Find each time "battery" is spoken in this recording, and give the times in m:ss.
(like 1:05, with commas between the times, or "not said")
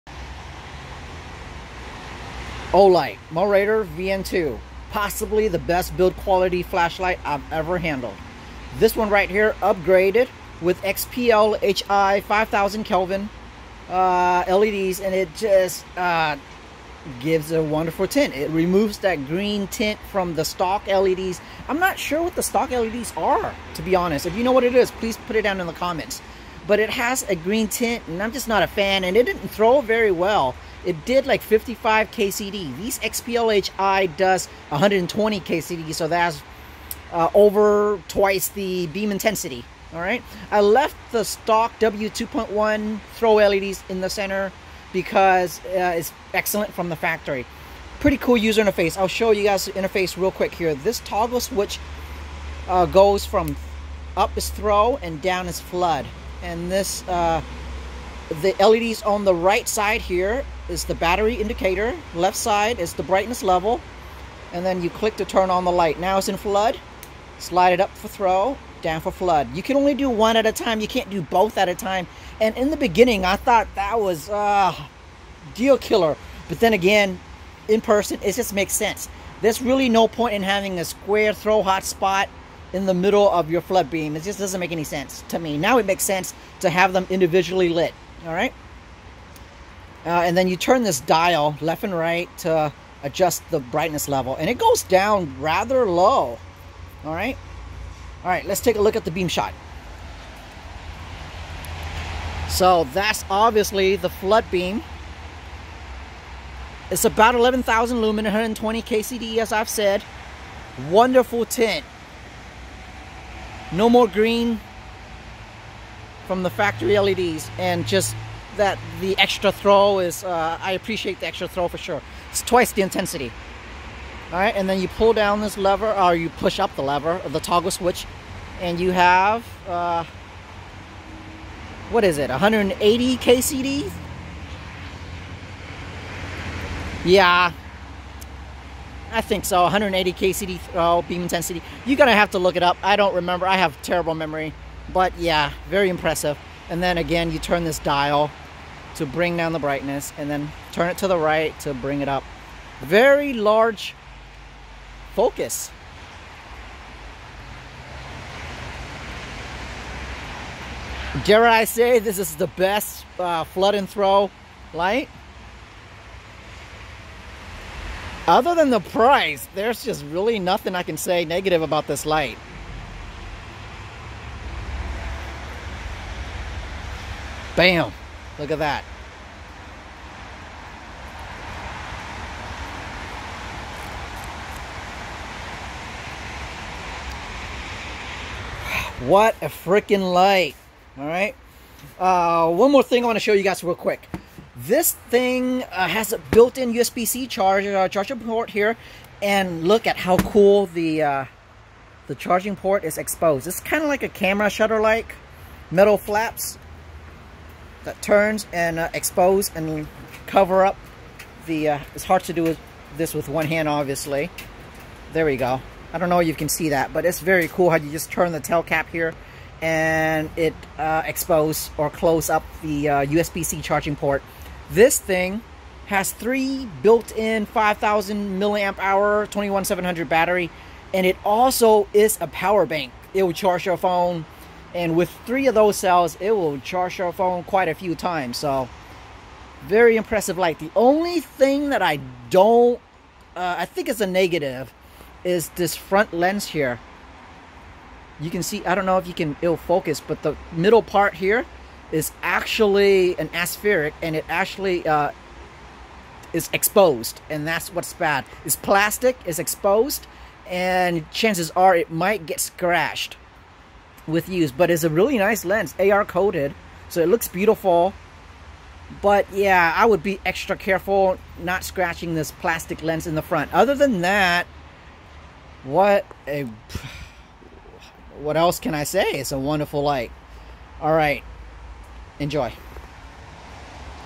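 1:00, 3:50.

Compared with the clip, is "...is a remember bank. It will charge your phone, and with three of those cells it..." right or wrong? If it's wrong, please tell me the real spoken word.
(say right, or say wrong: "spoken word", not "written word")
wrong: "power", not "remember".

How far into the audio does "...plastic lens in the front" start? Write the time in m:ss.
4:32.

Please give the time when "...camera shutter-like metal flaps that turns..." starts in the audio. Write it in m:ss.
3:24.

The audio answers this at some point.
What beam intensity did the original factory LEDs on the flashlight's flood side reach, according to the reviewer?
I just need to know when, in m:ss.
0:31.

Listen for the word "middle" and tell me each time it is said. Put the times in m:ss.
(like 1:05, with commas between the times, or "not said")
1:22, 4:10.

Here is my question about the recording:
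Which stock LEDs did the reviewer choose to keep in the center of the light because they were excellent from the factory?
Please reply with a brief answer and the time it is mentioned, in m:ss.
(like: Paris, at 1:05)
W2.1, at 0:41.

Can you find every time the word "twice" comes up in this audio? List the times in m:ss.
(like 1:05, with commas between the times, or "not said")
0:38, 2:02.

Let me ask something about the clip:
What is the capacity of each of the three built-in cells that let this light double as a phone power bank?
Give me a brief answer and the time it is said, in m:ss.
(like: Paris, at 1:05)
5,000 mAh, at 3:47.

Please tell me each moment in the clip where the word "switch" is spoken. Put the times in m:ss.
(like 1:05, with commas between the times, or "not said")
0:51, 2:07.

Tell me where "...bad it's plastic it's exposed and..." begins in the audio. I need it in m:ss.
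4:17.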